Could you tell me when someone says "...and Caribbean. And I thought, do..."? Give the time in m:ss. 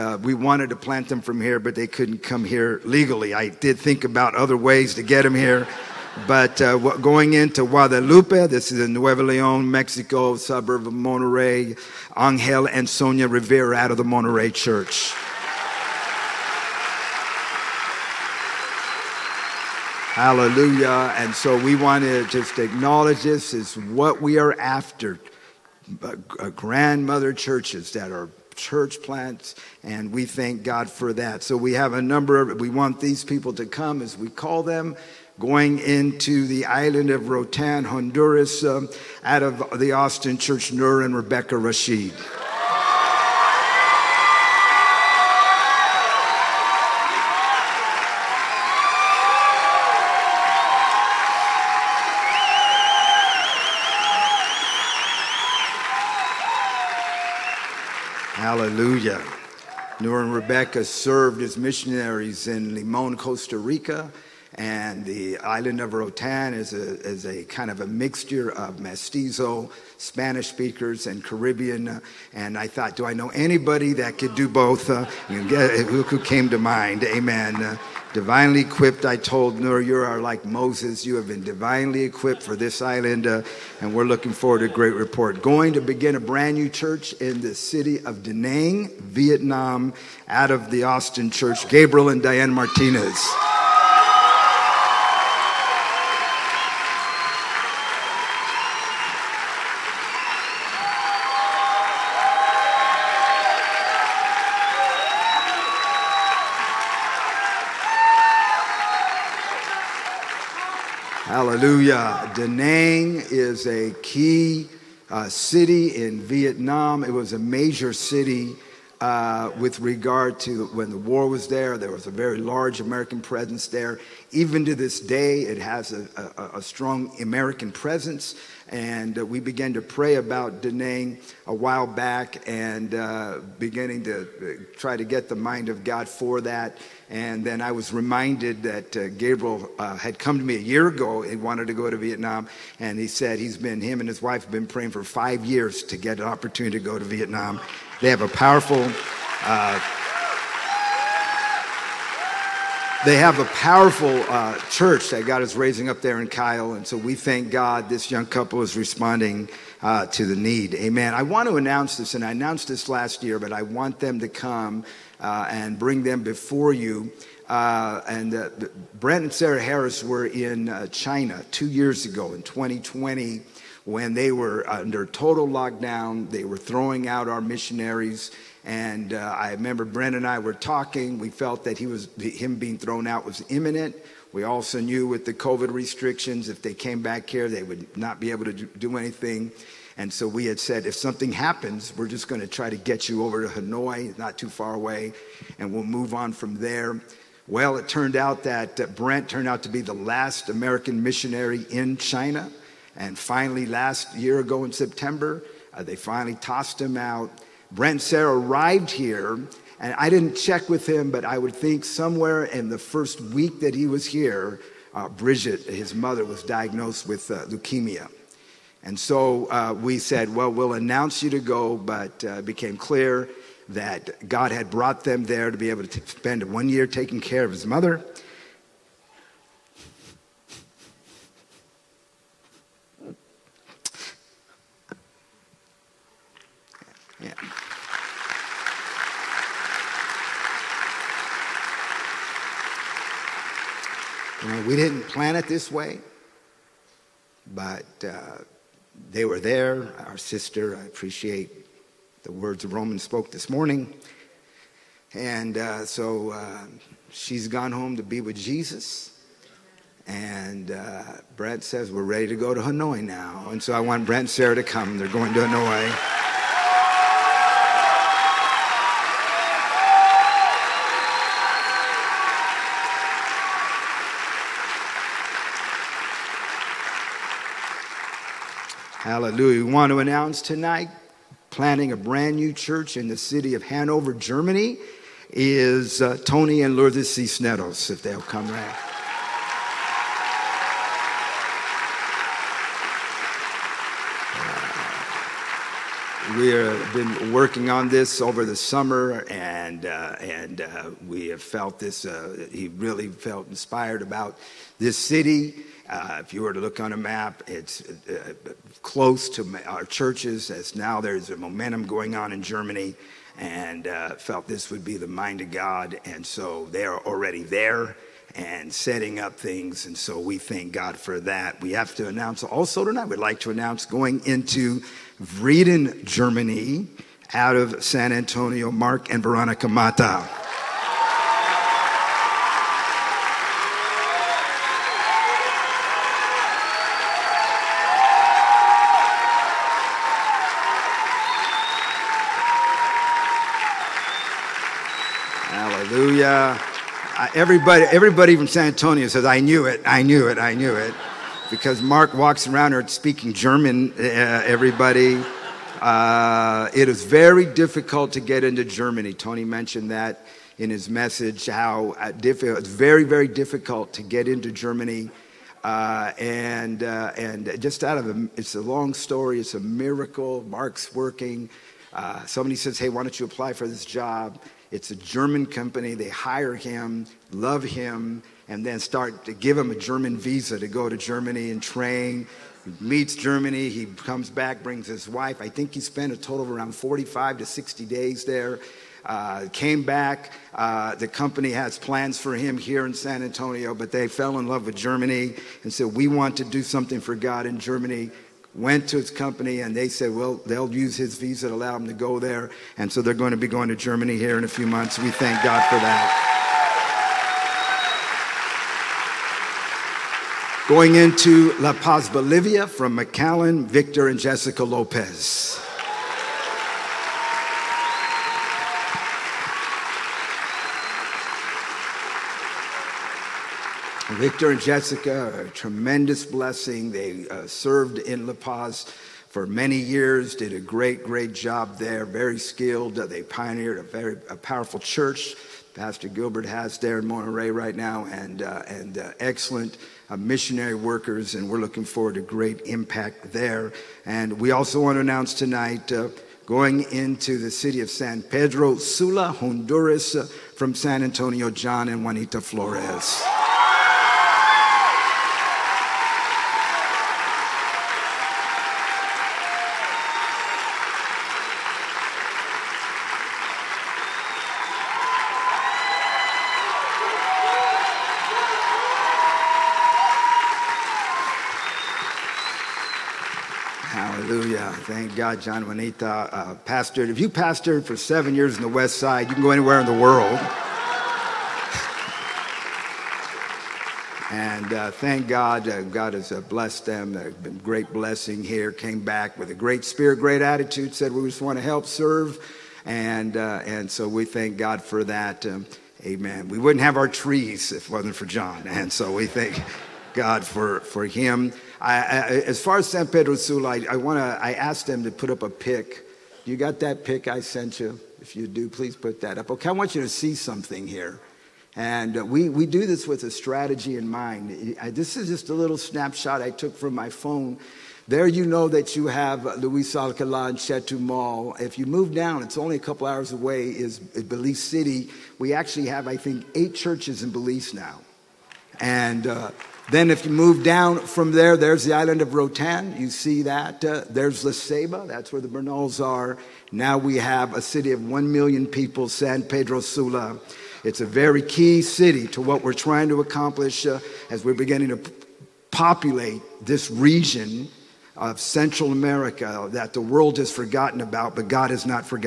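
1:11.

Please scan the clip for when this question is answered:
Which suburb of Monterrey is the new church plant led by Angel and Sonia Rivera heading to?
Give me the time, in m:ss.
0:07.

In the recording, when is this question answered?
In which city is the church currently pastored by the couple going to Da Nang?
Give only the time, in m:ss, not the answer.
2:36.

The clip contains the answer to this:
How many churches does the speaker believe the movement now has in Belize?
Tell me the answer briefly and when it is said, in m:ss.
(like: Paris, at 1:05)
8, at 8:46.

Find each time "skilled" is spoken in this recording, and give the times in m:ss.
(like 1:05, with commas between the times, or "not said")
7:12.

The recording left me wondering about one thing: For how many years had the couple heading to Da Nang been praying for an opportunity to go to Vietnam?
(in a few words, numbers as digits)
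5.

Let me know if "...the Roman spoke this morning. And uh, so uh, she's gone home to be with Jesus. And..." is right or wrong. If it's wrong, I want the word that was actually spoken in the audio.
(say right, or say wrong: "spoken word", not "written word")
right.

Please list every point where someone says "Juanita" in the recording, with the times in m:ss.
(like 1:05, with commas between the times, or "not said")
7:32, 7:55.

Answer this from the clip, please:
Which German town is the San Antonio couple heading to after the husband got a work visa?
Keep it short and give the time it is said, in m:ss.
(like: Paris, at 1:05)
Vreden, at 5:25.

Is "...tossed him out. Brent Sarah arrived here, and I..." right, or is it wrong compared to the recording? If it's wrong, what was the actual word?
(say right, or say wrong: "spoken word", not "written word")
right.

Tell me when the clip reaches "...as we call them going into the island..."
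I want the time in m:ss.
0:33.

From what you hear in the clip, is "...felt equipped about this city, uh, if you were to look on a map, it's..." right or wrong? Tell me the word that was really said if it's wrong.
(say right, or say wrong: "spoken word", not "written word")
wrong: "inspired", not "equipped".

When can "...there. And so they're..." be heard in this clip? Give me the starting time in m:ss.
6:42.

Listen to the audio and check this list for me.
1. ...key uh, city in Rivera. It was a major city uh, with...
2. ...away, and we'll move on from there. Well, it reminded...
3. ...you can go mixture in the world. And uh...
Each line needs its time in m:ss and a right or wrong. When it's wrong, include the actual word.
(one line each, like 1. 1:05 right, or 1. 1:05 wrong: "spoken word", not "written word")
1. 1:54 wrong: "Vietnam", not "Rivera"
2. 3:14 wrong: "turned", not "reminded"
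3. 7:59 wrong: "anywhere", not "mixture".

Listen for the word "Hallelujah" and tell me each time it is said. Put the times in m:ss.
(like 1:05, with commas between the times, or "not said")
0:20, 0:58, 1:51, 4:39.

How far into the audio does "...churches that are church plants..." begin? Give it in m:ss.
0:27.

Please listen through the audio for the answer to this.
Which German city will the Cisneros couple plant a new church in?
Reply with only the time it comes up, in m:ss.
4:43.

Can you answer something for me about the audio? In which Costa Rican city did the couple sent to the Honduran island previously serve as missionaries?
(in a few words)
Limon.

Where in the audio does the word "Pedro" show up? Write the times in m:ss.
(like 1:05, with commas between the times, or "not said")
7:28, 8:23, 8:59.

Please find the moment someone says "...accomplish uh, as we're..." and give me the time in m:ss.
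9:03.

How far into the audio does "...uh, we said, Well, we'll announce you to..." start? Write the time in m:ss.
3:39.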